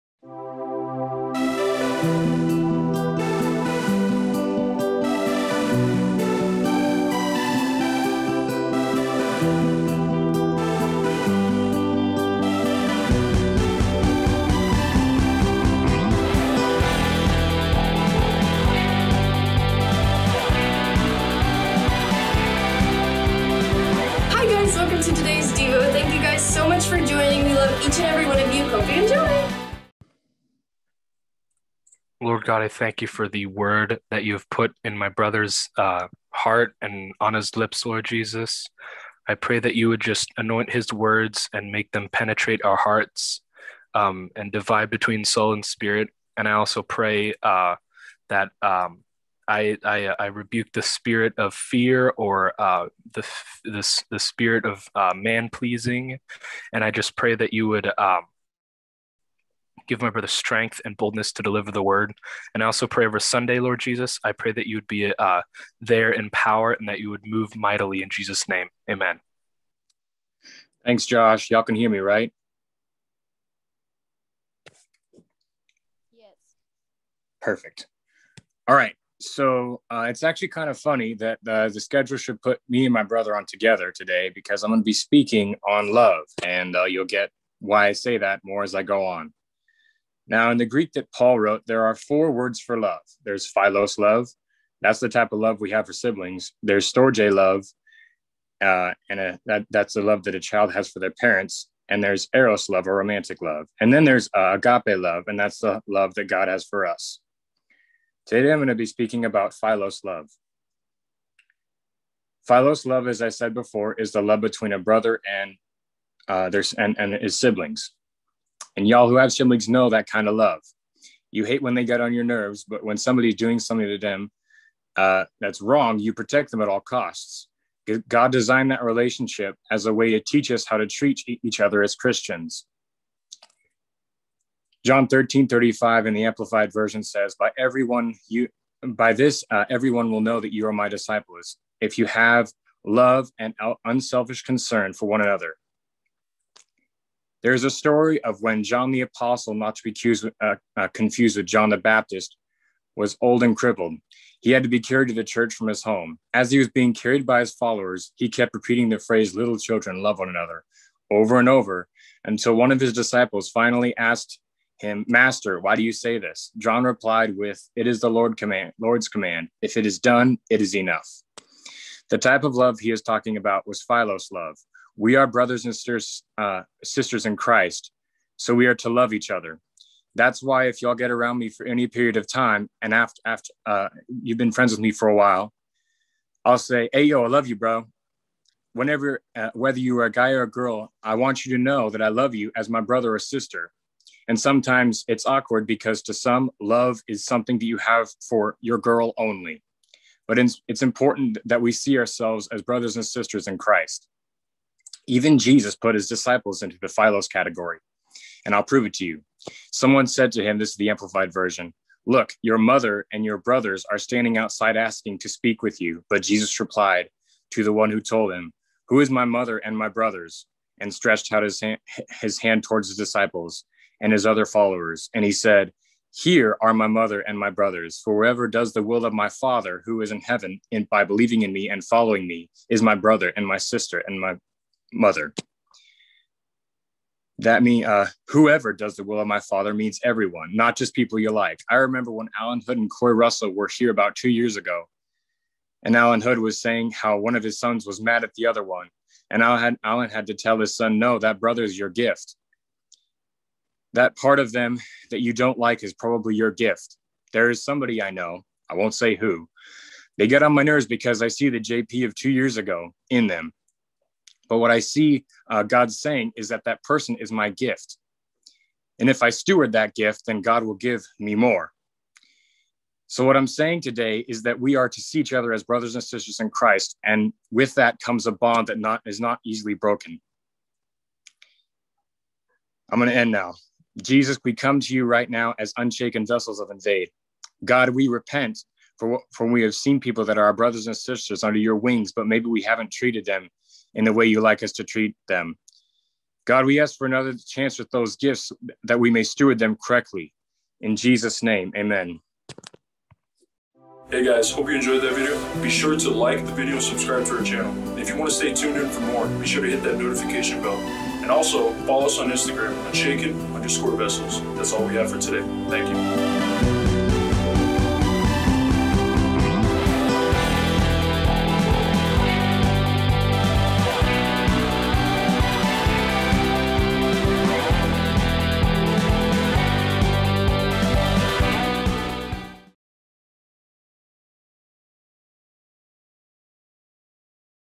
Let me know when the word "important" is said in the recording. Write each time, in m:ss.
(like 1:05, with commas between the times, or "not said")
3:20.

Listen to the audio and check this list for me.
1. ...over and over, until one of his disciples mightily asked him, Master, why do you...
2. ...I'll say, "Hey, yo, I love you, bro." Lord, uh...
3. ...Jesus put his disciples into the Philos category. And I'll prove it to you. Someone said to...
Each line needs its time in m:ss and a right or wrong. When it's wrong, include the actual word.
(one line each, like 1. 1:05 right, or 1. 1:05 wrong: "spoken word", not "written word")
1. 2:41 wrong: "finally", not "mightily"
2. 3:06 wrong: "Whenever", not "Lord"
3. 3:25 right.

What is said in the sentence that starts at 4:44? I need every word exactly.
Jesus, we come to you right now as unshaken vessels of invade.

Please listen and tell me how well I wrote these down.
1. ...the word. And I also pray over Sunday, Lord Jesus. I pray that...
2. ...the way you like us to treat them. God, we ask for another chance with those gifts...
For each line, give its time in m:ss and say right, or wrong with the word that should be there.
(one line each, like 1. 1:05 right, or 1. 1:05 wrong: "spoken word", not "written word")
1. 1:01 right
2. 4:54 right.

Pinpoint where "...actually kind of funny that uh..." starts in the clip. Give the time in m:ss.
1:20.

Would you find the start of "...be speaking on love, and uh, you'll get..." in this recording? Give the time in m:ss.
1:24.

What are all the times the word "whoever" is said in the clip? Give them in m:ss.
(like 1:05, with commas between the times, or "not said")
3:48, 3:58.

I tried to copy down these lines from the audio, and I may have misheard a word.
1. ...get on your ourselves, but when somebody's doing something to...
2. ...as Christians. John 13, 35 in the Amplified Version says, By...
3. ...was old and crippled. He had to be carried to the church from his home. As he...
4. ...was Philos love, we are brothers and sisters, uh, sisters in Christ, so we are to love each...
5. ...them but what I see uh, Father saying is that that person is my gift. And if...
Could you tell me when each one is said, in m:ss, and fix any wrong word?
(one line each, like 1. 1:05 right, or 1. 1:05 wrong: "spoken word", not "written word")
1. 2:01 wrong: "nerves", not "ourselves"
2. 2:11 right
3. 2:32 right
4. 2:53 right
5. 4:23 wrong: "God", not "Father".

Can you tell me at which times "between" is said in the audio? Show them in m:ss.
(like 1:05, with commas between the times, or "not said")
0:44, 1:54.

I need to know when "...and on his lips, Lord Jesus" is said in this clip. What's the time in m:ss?
0:36.